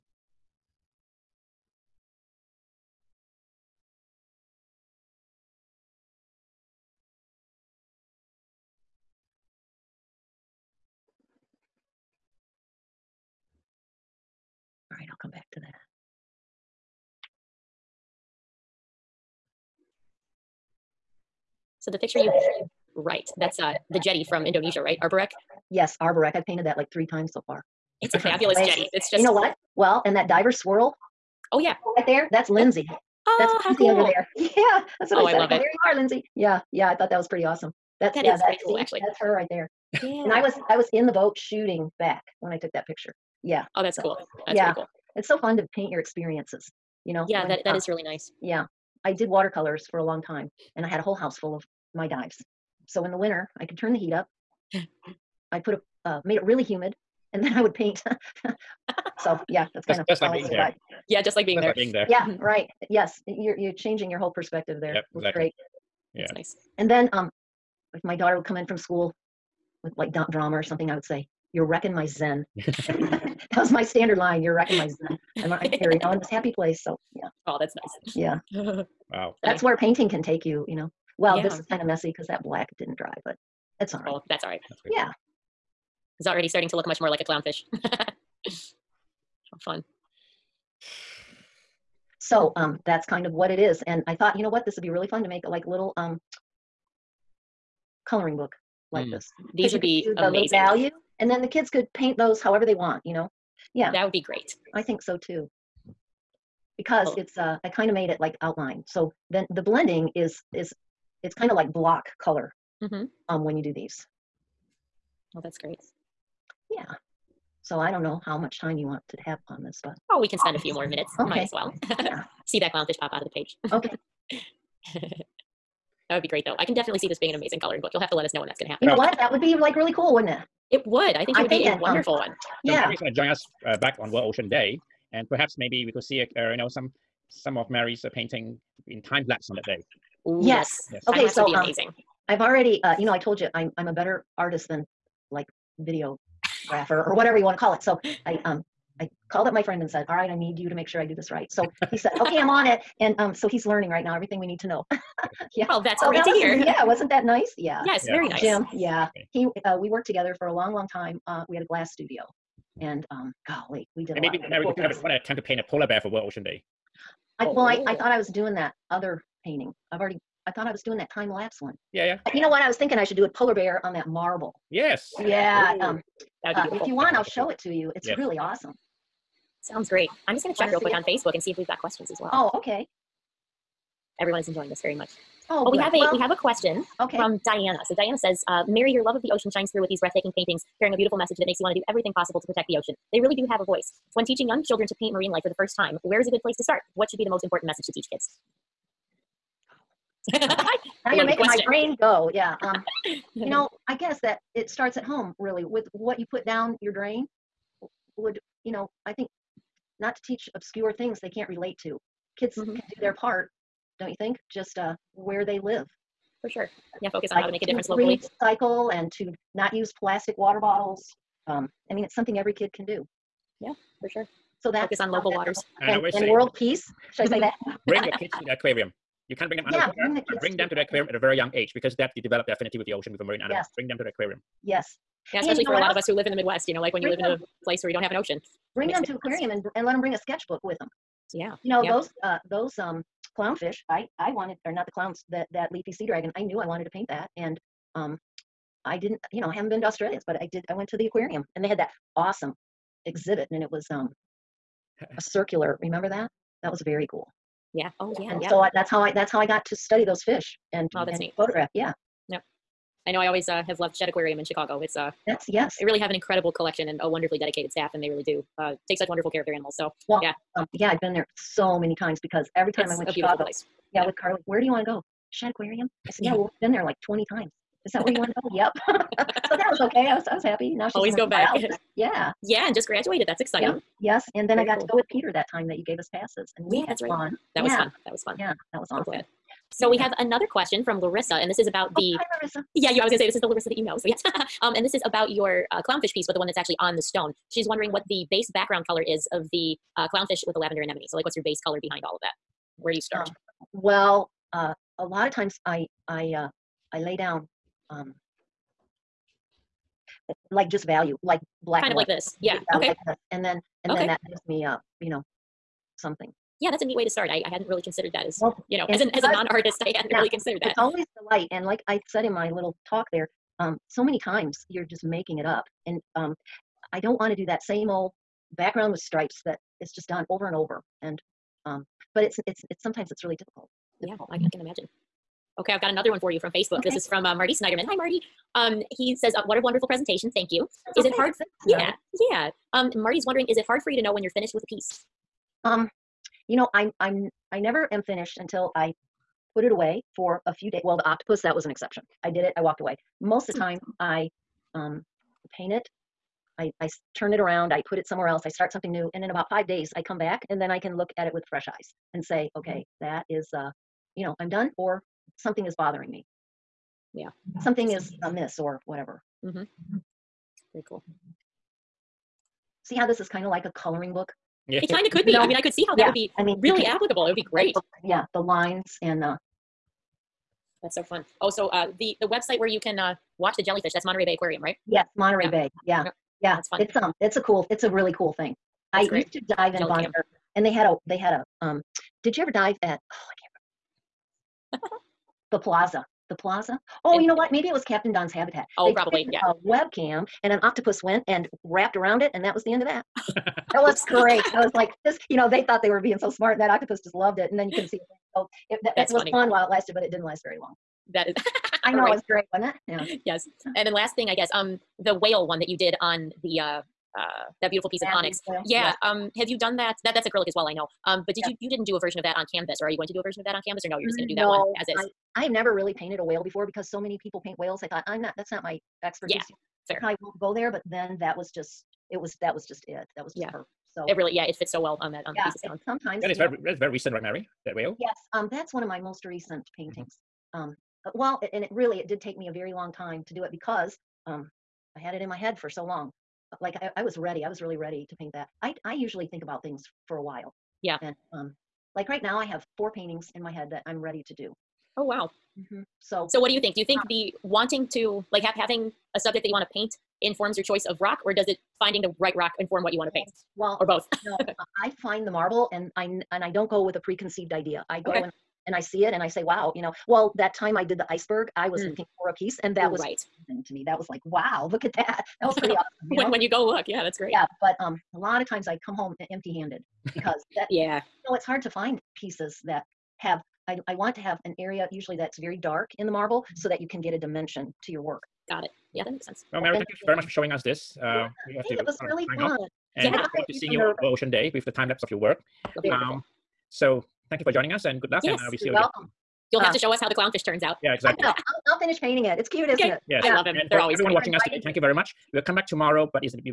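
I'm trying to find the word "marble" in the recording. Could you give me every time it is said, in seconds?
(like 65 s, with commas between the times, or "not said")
174 s, 465 s, 486 s.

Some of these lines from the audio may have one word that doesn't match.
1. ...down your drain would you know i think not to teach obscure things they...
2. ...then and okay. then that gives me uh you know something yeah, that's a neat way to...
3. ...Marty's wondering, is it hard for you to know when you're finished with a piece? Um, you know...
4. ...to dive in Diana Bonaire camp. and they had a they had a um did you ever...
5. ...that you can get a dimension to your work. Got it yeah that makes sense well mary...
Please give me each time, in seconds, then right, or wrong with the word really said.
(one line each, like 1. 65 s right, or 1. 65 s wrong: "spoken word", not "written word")
1. 206 s right
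2. 313 s right
3. 342 s right
4. 389 s wrong: "Jelly", not "Diana"
5. 486 s right.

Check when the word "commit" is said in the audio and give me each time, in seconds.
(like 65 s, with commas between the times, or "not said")
not said.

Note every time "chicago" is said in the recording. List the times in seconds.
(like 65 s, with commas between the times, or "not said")
264 s, 273 s.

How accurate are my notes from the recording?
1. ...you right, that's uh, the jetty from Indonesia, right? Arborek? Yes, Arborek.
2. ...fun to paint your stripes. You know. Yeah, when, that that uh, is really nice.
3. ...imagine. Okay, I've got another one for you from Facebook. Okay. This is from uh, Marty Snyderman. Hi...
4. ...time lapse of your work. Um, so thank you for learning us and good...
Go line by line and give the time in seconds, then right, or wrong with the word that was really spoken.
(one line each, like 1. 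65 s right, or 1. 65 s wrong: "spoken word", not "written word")
1. 22 s right
2. 45 s wrong: "experiences", not "stripes"
3. 334 s right
4. 494 s wrong: "joining", not "learning".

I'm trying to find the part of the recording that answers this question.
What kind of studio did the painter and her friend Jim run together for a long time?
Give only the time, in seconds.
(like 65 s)
161 s.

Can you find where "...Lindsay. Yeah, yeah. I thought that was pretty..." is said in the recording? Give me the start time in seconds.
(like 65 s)
35 s.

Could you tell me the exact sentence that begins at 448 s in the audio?
I I usually think about things for a while.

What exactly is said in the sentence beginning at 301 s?
So, like, what's your base color behind all of that?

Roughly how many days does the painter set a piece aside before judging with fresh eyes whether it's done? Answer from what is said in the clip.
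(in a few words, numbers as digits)
5.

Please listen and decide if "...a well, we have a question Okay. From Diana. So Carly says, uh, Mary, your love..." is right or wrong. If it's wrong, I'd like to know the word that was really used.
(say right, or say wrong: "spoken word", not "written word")
wrong: "Diana", not "Carly".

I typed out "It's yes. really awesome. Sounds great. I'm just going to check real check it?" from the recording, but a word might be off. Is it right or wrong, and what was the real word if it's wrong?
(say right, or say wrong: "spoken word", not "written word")
wrong: "quick", not "check".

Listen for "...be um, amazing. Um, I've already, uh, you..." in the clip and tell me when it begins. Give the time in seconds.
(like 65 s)
141 s.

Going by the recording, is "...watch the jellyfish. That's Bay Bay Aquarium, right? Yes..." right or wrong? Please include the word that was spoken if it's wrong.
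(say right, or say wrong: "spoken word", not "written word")
wrong: "Monterey", not "Bay".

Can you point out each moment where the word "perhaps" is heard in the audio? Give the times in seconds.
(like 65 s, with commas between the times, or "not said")
135 s.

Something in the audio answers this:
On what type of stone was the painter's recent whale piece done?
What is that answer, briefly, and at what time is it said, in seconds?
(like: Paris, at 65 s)
Onyx, at 418 s.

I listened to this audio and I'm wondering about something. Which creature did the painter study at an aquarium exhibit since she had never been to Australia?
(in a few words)
Leafy sea dragon.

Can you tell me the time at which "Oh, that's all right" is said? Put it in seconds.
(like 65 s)
84 s.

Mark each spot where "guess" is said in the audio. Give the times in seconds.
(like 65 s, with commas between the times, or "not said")
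203 s, 414 s.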